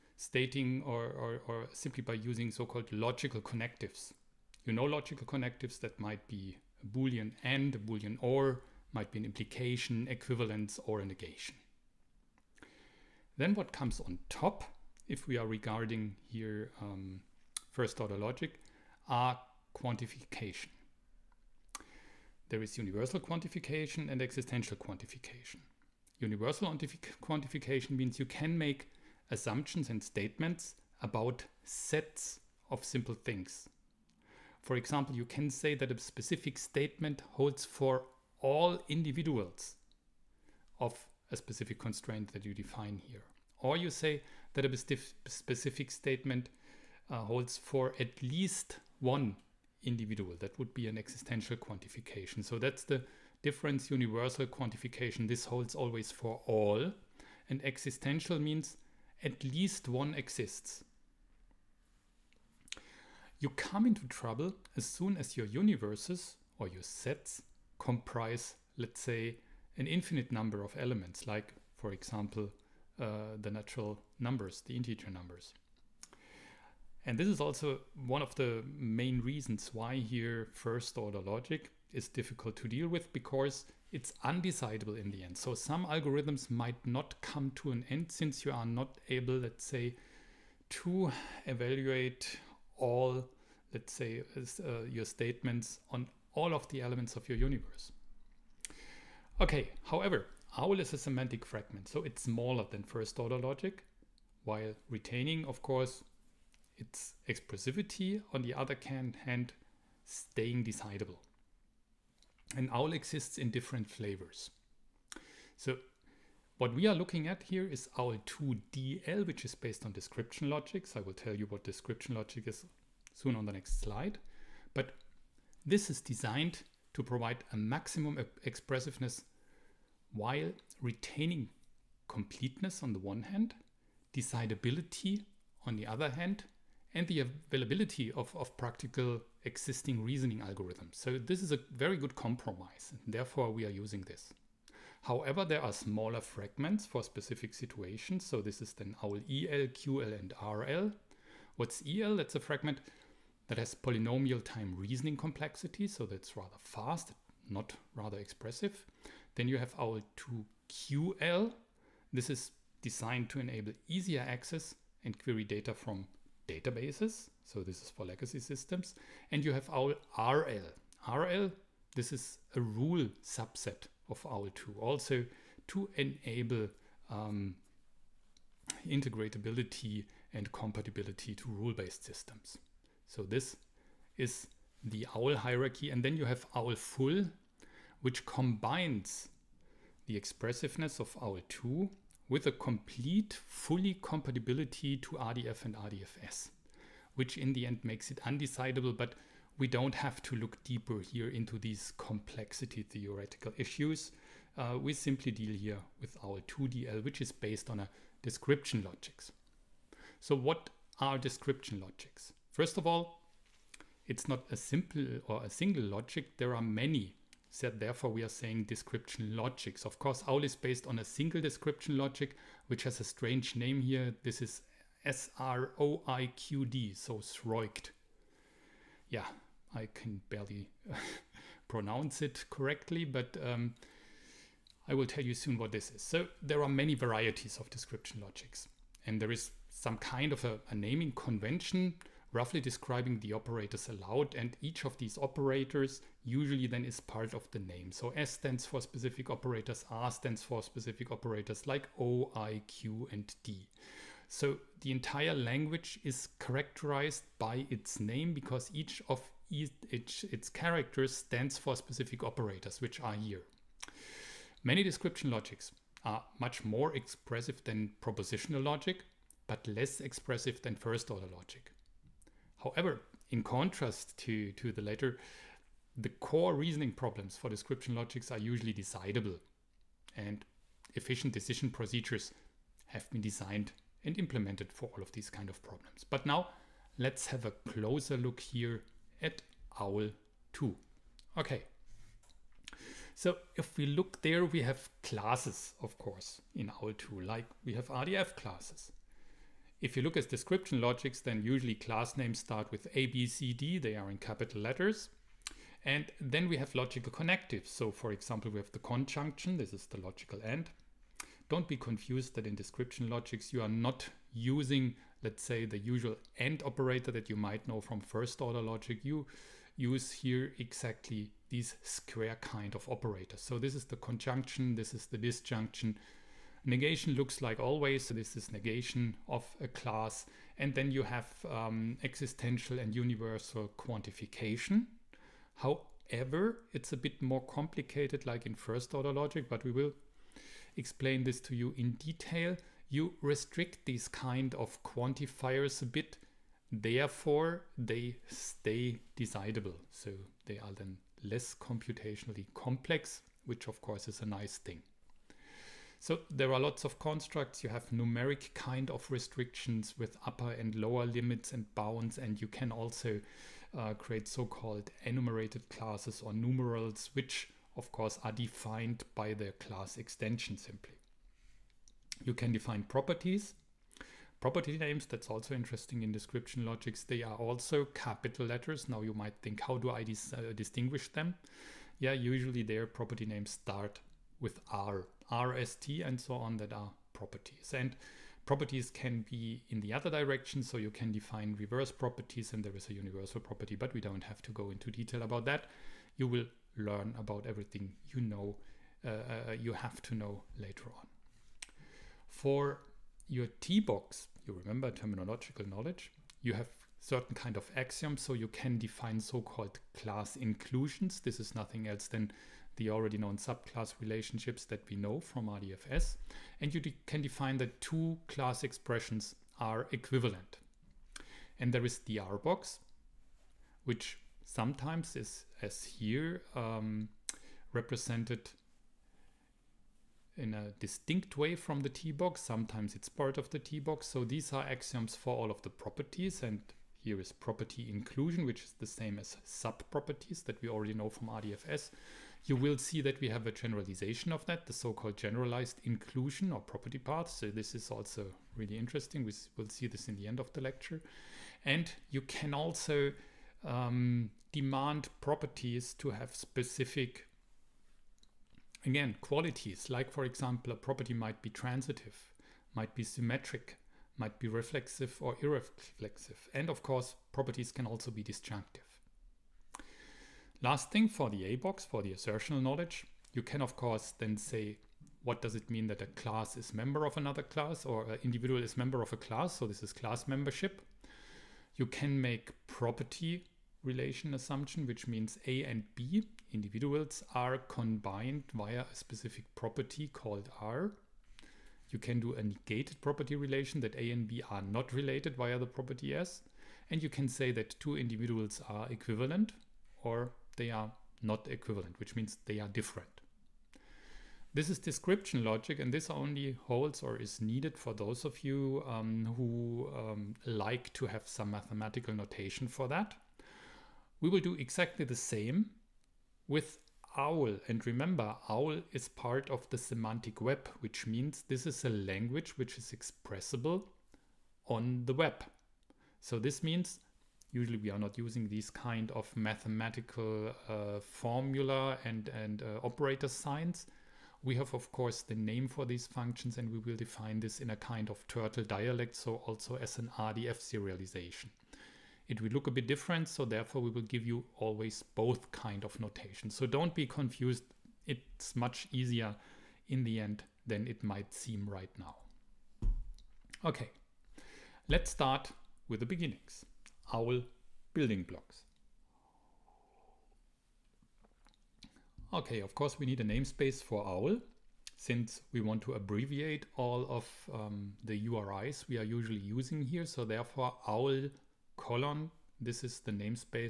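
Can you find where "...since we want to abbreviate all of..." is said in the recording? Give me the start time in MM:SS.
09:24.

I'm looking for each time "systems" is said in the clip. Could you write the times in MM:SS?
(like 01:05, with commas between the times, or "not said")
02:48, 03:02.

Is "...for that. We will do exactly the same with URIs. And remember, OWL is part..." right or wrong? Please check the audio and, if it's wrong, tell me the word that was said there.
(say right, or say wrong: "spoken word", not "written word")
wrong: "OWL", not "URIs".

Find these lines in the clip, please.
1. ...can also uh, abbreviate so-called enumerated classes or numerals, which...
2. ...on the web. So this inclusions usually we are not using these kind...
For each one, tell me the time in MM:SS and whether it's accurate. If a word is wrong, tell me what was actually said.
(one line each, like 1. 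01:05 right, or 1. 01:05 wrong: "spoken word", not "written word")
1. 06:02 wrong: "create", not "abbreviate"
2. 08:44 wrong: "means", not "inclusions".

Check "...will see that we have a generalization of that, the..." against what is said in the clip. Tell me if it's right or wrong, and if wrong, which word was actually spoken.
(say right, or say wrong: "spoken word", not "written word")
right.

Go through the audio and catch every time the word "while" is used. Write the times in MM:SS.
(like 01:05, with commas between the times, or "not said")
01:44, 02:10.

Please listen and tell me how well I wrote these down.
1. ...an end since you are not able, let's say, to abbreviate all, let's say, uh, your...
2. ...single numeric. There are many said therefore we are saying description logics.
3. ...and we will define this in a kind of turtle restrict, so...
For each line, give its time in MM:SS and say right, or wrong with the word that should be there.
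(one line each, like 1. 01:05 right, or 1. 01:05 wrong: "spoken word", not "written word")
1. 01:27 wrong: "evaluate", not "abbreviate"
2. 03:35 wrong: "logic", not "numeric"
3. 08:56 wrong: "dialect", not "restrict".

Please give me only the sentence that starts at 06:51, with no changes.
This is nothing else than the already known subclass relationships that we know from RDFS.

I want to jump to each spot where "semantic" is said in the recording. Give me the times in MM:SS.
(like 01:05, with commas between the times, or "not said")
01:40, 08:39.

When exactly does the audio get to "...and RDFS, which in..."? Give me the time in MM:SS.
03:15.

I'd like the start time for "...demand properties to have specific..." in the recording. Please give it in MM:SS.
07:34.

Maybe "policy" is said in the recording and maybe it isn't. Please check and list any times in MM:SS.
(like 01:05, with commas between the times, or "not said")
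not said.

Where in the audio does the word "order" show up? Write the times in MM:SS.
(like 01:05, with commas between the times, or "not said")
00:18, 01:20, 01:43, 04:31, 05:18, 05:38.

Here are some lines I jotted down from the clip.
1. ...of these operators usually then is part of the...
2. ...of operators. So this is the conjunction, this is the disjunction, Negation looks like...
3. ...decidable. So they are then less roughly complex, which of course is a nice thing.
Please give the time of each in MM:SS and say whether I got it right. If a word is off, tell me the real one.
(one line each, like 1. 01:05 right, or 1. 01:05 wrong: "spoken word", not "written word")
1. 04:04 right
2. 05:22 right
3. 05:49 wrong: "computationally", not "roughly".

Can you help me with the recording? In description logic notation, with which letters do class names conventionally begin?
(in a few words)
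A, B, C, D.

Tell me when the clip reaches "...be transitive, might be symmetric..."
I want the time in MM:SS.
07:41.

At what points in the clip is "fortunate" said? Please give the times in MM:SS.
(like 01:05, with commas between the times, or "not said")
not said.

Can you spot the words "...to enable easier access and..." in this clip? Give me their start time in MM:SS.
02:43.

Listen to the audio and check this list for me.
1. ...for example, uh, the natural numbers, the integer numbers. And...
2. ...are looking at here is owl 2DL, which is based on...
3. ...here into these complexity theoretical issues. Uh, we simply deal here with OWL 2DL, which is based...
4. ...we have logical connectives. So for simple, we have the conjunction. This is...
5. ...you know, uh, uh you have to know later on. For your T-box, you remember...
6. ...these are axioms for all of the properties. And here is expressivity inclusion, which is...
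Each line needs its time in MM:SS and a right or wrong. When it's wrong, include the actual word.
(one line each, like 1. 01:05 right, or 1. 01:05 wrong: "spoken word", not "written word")
1. 01:11 right
2. 01:56 right
3. 03:20 right
4. 05:06 wrong: "example", not "simple"
5. 06:38 right
6. 07:14 wrong: "property", not "expressivity".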